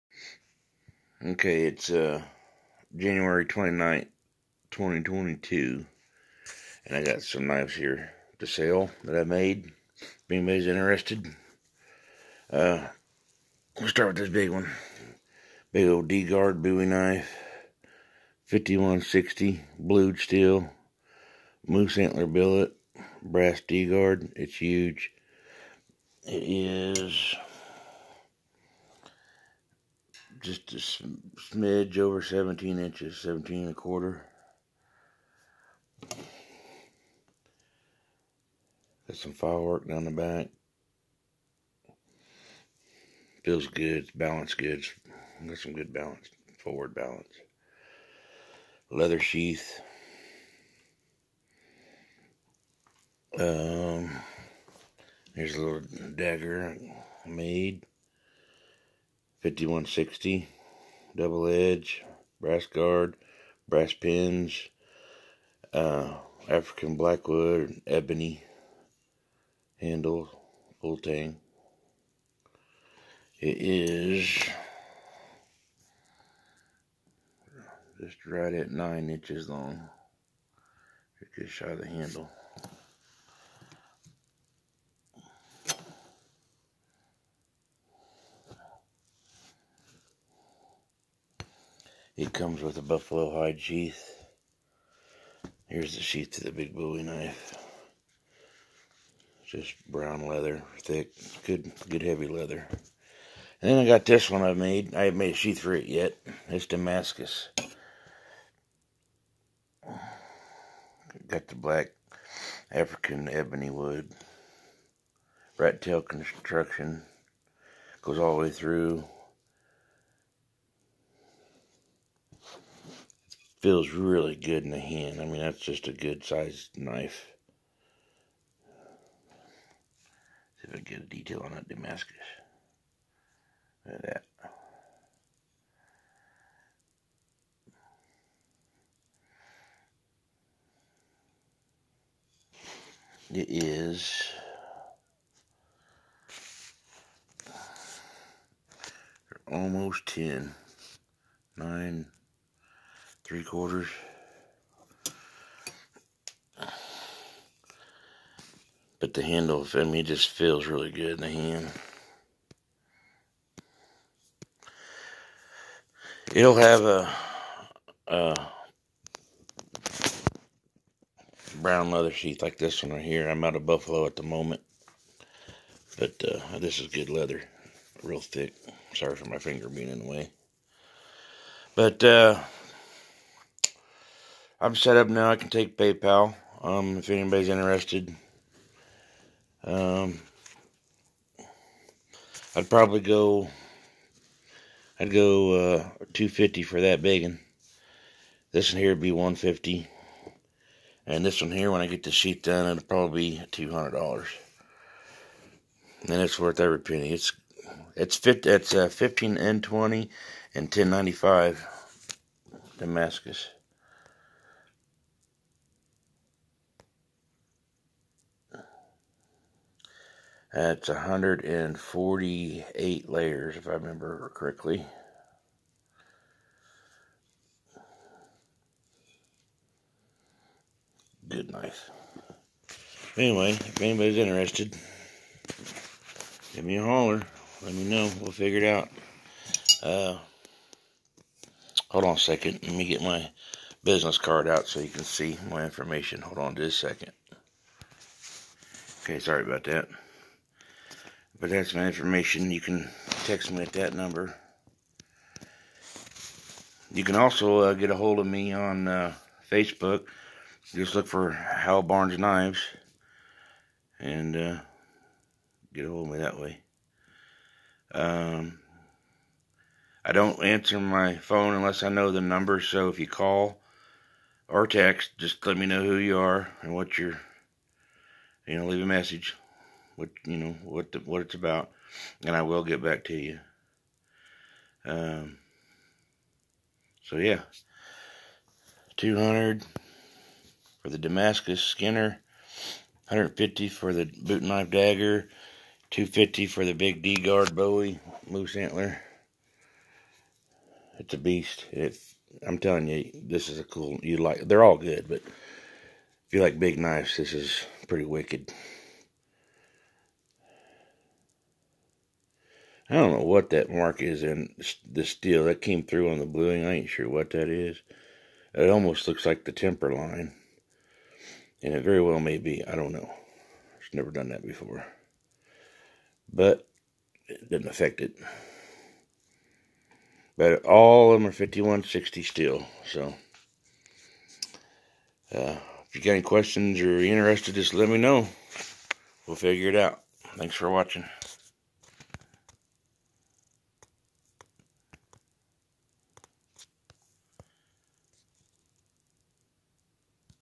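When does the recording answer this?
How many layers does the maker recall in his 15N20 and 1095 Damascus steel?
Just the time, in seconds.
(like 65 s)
220 s.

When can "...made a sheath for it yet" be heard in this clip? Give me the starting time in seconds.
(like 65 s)
105 s.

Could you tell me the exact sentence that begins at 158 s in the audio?
But the handle, I mean, just feels really good in the hand.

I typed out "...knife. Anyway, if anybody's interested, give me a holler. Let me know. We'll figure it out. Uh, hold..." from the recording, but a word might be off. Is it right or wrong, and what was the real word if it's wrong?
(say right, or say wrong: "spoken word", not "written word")
right.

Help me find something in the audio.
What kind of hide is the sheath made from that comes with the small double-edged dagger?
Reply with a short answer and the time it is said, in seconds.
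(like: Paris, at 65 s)
buffalo hide, at 92 s.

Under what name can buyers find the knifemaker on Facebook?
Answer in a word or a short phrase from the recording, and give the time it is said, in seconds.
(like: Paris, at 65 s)
Hal Barnes Knives, at 261 s.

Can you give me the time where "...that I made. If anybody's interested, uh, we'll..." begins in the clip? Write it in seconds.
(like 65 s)
9 s.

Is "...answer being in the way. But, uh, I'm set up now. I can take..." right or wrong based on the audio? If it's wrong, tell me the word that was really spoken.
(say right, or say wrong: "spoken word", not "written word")
wrong: "finger", not "answer".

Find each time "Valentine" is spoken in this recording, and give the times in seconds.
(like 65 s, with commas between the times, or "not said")
not said.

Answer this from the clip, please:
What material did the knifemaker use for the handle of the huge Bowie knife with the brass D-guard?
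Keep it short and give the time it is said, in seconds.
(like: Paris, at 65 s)
moose antler billet, at 21 s.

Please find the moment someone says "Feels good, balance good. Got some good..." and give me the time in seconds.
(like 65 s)
43 s.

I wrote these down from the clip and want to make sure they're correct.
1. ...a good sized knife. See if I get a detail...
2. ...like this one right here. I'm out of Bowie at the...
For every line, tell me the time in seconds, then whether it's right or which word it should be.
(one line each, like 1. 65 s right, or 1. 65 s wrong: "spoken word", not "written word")
1. 125 s right
2. 172 s wrong: "Buffalo", not "Bowie".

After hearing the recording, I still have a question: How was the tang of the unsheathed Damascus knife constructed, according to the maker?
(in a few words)
rat tail construction.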